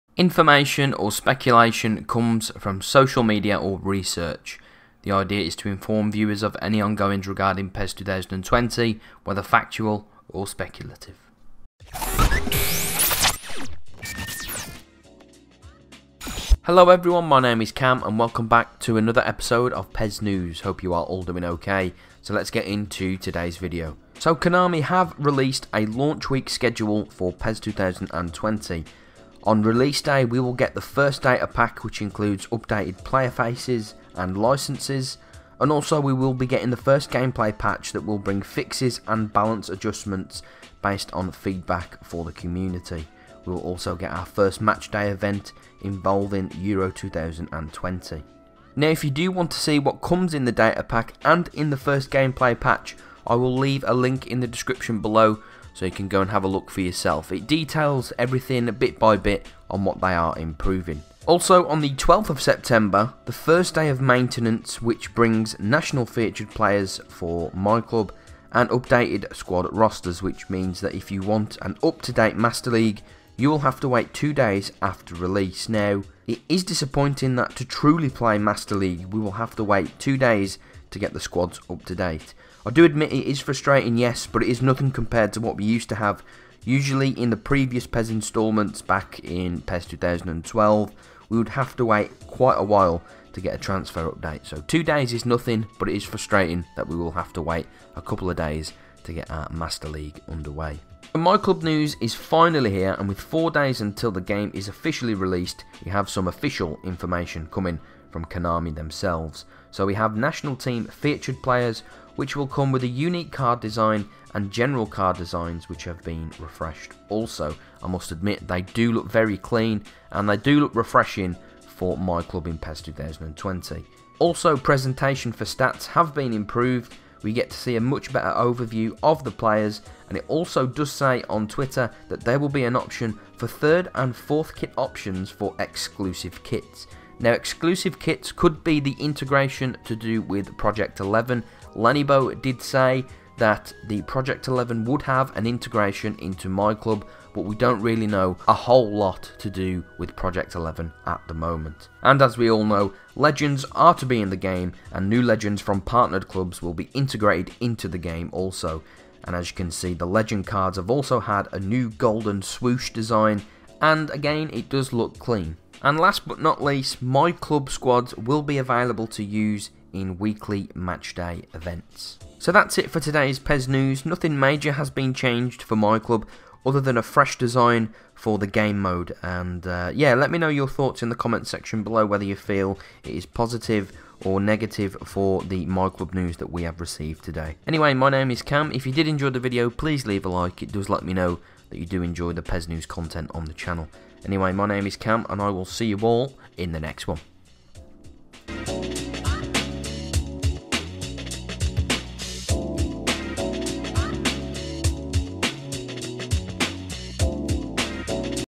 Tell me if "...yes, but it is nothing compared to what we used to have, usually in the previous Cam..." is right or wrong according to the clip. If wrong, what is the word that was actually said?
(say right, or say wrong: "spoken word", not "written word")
wrong: "PES", not "Cam".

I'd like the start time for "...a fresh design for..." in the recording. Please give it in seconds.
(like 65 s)
176 s.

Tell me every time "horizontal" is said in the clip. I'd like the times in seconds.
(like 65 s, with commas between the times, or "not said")
not said.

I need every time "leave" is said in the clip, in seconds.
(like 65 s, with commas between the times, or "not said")
53 s, 190 s.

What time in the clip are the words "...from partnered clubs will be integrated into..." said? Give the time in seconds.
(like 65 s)
155 s.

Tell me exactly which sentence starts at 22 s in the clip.
So let's get into today's video.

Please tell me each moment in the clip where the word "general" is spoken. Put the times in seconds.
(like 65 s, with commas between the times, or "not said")
114 s.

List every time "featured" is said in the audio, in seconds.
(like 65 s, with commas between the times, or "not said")
66 s, 110 s.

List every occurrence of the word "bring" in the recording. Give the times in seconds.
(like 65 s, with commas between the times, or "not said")
38 s, 65 s.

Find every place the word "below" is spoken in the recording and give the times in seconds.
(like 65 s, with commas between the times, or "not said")
54 s, 181 s.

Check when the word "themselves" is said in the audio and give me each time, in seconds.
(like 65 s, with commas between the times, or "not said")
108 s.